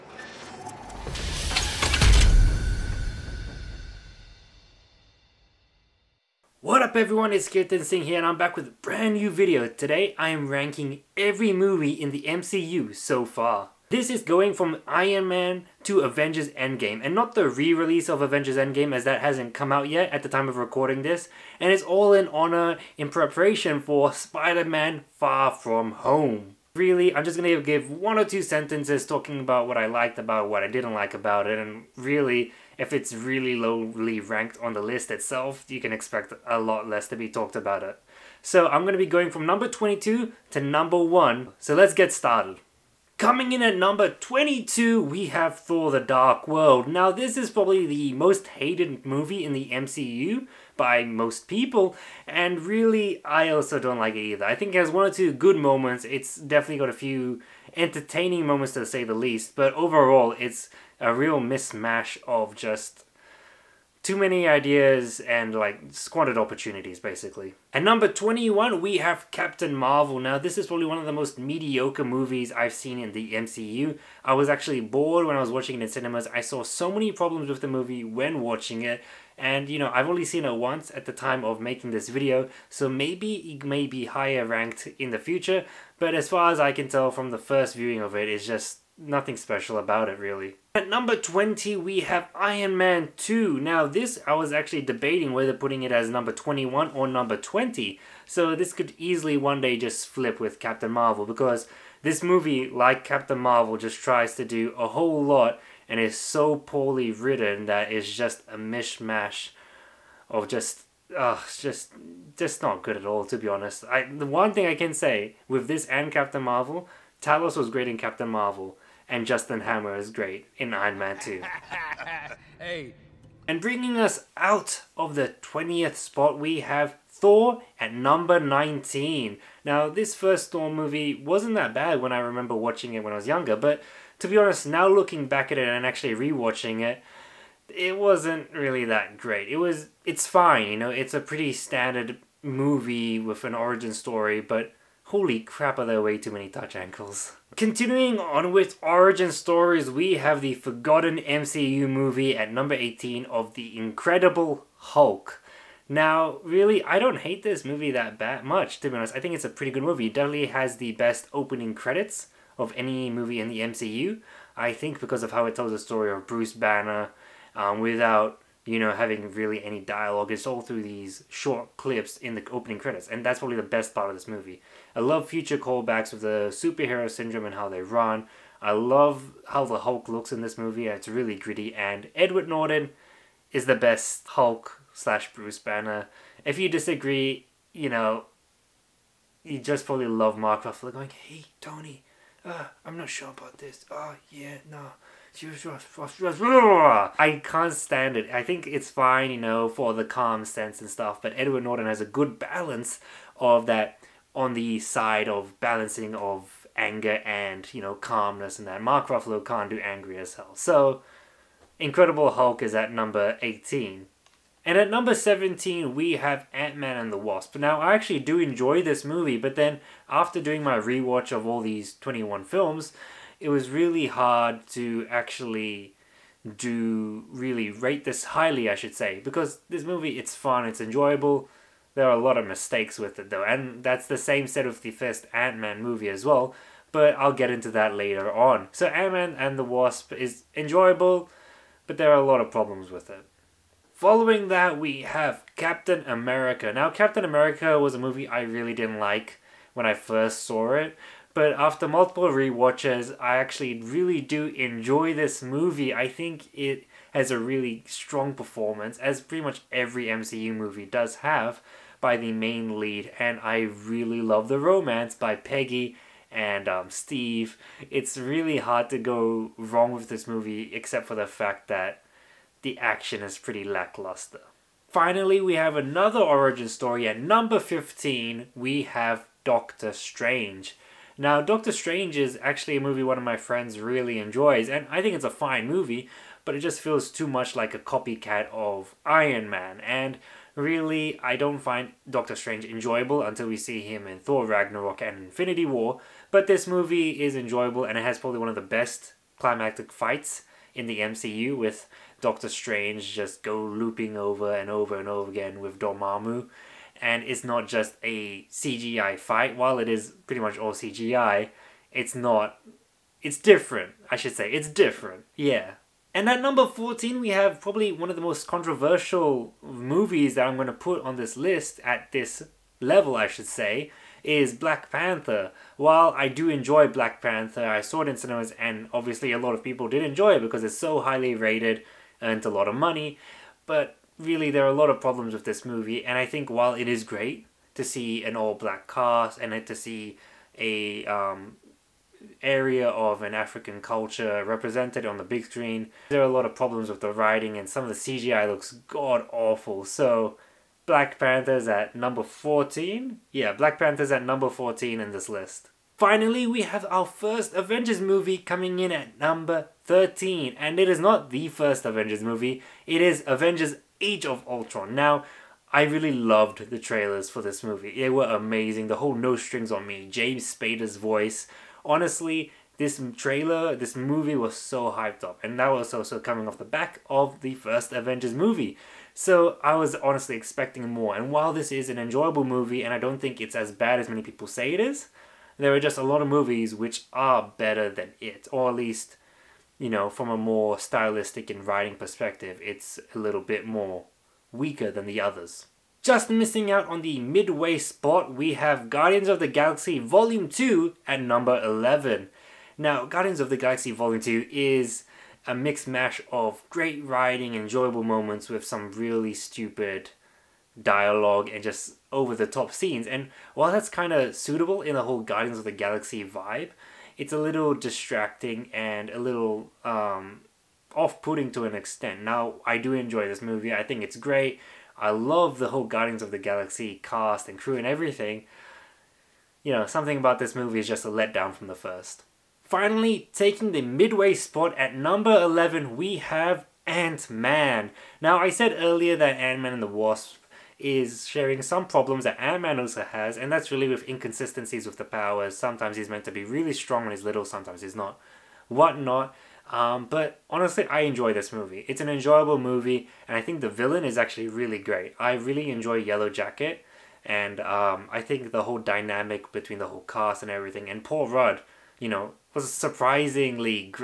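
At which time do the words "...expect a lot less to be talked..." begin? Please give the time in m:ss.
0:35.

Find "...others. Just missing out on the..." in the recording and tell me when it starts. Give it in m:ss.
6:35.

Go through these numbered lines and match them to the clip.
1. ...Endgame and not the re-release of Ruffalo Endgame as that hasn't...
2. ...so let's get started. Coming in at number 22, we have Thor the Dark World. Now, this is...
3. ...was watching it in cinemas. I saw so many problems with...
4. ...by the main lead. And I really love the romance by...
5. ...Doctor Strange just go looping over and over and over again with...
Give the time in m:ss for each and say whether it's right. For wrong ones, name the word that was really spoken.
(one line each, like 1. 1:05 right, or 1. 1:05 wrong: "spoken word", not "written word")
1. 0:16 wrong: "Avengers", not "Ruffalo"
2. 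0:41 right
3. 1:15 right
4. 4:22 right
5. 5:02 right.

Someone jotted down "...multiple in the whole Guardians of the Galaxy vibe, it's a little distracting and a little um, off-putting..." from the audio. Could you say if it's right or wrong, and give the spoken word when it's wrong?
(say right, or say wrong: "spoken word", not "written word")
wrong: "suitable", not "multiple".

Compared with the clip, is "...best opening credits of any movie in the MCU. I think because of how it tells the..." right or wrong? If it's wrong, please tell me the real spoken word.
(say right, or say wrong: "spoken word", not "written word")
right.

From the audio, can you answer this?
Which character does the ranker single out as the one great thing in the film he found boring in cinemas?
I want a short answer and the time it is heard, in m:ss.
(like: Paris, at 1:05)
Talos, at 1:57.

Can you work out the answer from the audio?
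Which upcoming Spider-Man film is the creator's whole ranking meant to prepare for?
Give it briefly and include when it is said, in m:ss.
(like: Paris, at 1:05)
Spider-Man Far From Home, at 0:24.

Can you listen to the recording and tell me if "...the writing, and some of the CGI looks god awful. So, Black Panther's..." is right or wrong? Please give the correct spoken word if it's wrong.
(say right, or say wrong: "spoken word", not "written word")
right.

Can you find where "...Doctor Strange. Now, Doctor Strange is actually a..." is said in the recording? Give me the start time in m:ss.
4:39.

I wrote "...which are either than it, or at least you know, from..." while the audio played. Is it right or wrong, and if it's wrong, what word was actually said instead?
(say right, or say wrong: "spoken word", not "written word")
wrong: "better", not "either".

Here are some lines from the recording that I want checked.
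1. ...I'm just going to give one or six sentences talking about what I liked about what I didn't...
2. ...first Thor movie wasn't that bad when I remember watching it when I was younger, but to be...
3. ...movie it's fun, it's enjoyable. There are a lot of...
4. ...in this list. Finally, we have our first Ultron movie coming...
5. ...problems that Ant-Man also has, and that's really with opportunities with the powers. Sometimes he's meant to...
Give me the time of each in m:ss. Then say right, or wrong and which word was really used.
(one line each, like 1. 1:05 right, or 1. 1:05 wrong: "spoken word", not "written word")
1. 0:27 wrong: "two", not "six"
2. 2:10 right
3. 3:49 right
4. 5:55 wrong: "Avengers", not "Ultron"
5. 7:21 wrong: "inconsistencies", not "opportunities".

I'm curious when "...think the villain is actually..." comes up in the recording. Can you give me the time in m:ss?
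7:33.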